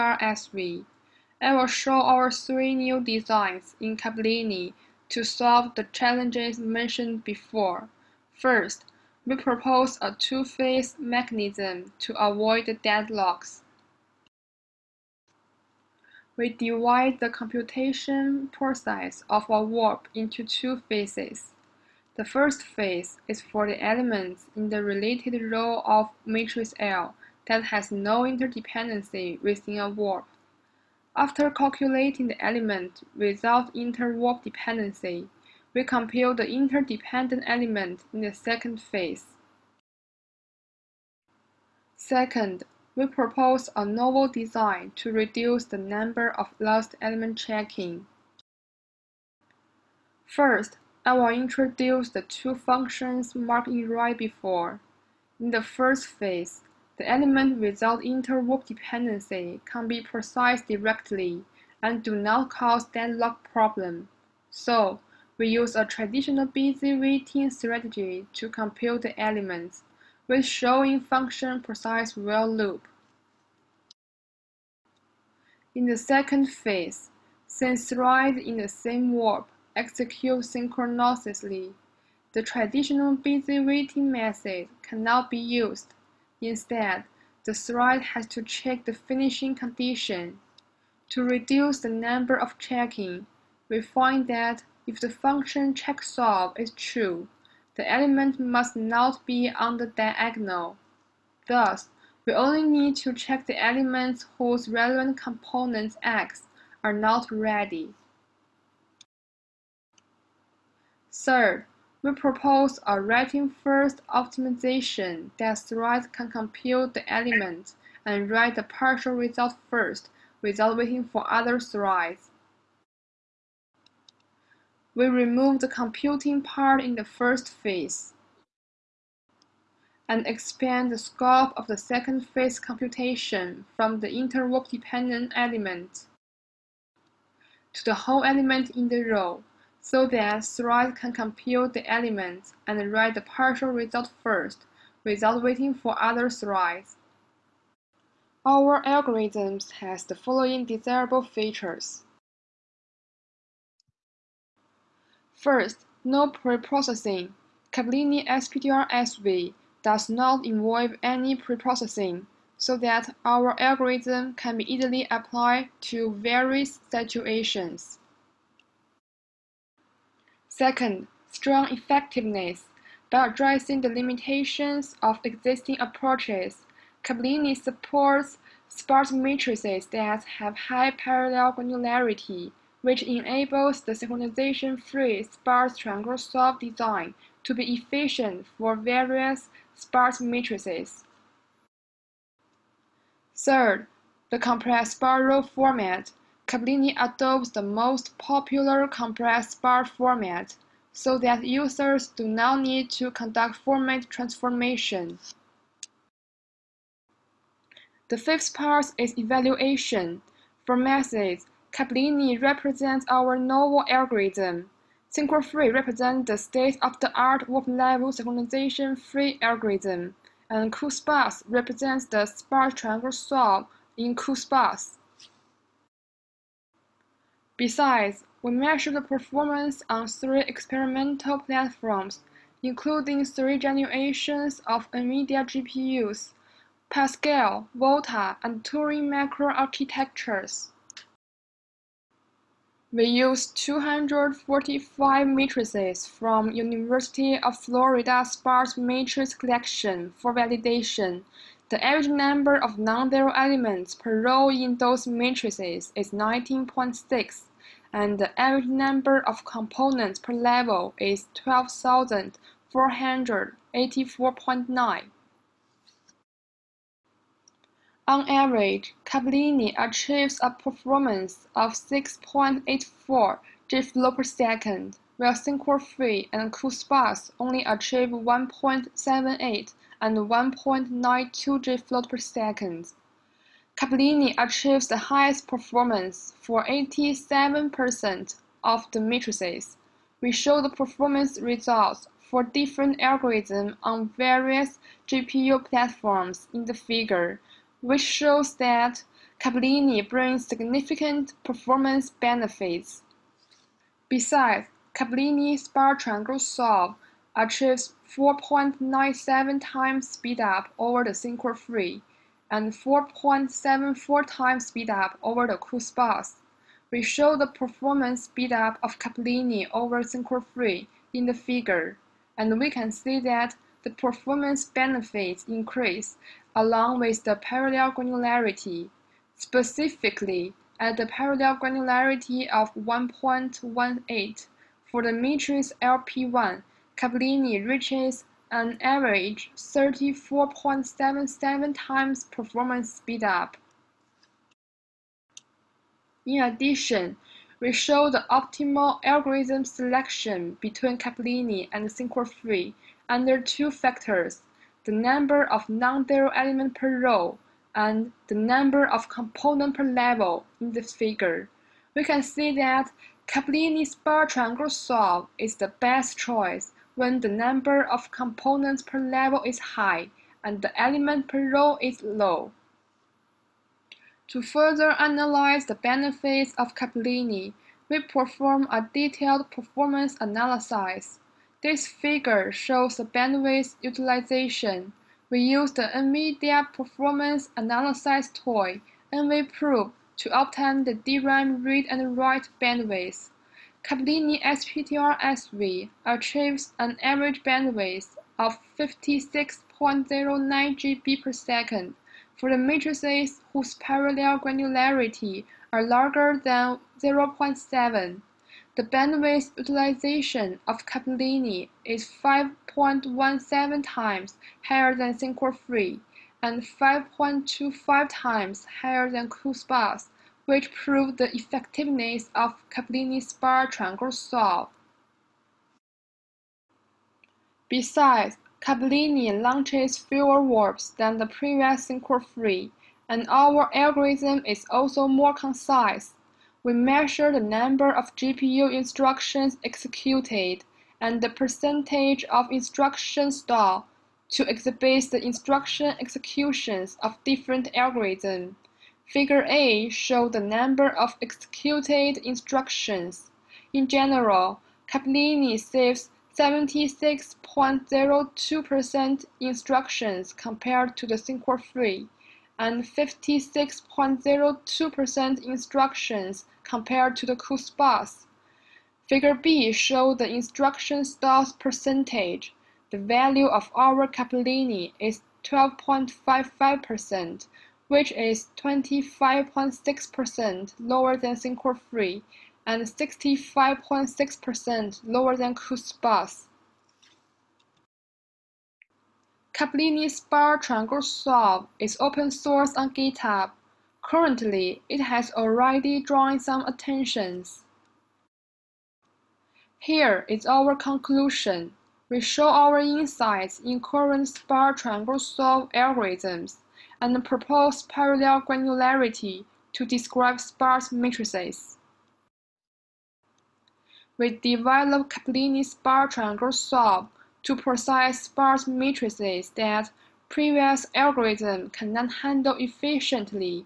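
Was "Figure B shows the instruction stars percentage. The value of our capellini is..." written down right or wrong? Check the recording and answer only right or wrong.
right.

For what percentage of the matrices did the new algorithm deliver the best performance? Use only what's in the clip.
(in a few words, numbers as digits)
87%.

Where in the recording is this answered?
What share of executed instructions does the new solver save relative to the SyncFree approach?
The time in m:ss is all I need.
7:36.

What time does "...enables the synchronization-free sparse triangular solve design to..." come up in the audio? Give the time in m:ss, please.
3:03.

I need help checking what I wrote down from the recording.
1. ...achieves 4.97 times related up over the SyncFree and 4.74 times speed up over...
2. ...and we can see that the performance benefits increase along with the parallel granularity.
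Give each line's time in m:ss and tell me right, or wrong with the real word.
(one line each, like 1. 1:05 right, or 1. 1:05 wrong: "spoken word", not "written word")
1. 5:07 wrong: "speed", not "related"
2. 5:22 right.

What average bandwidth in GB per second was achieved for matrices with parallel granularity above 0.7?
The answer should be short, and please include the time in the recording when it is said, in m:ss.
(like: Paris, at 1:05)
56.09, at 6:38.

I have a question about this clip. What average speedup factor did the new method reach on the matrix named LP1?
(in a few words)
34.77.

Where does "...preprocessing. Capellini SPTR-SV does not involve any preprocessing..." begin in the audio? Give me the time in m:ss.
2:36.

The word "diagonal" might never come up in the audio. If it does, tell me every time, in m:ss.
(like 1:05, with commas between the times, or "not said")
1:39.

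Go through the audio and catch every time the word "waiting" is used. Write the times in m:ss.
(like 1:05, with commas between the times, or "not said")
1:06, 1:23, 2:00, 2:25.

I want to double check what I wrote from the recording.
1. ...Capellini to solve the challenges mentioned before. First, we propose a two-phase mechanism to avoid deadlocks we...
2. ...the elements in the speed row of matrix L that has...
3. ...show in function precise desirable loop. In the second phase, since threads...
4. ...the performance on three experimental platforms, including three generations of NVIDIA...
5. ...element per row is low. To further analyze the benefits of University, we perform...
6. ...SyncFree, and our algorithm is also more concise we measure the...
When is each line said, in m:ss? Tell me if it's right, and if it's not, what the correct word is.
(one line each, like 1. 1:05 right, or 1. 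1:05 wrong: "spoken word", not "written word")
1. 0:03 right
2. 0:23 wrong: "related", not "speed"
3. 1:10 wrong: "while", not "desirable"
4. 3:48 right
5. 6:10 wrong: "Capellini", not "University"
6. 7:11 right.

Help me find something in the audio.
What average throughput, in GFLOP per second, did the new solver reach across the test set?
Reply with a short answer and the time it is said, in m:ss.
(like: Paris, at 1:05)
6.84, at 4:31.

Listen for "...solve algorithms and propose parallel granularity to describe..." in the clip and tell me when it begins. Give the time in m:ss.
8:25.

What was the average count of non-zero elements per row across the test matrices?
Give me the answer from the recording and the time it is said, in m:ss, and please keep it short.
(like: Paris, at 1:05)
19.6, at 4:16.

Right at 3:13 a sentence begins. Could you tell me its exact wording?
Third, the compressed sparse row format.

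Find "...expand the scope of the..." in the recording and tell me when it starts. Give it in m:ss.
2:10.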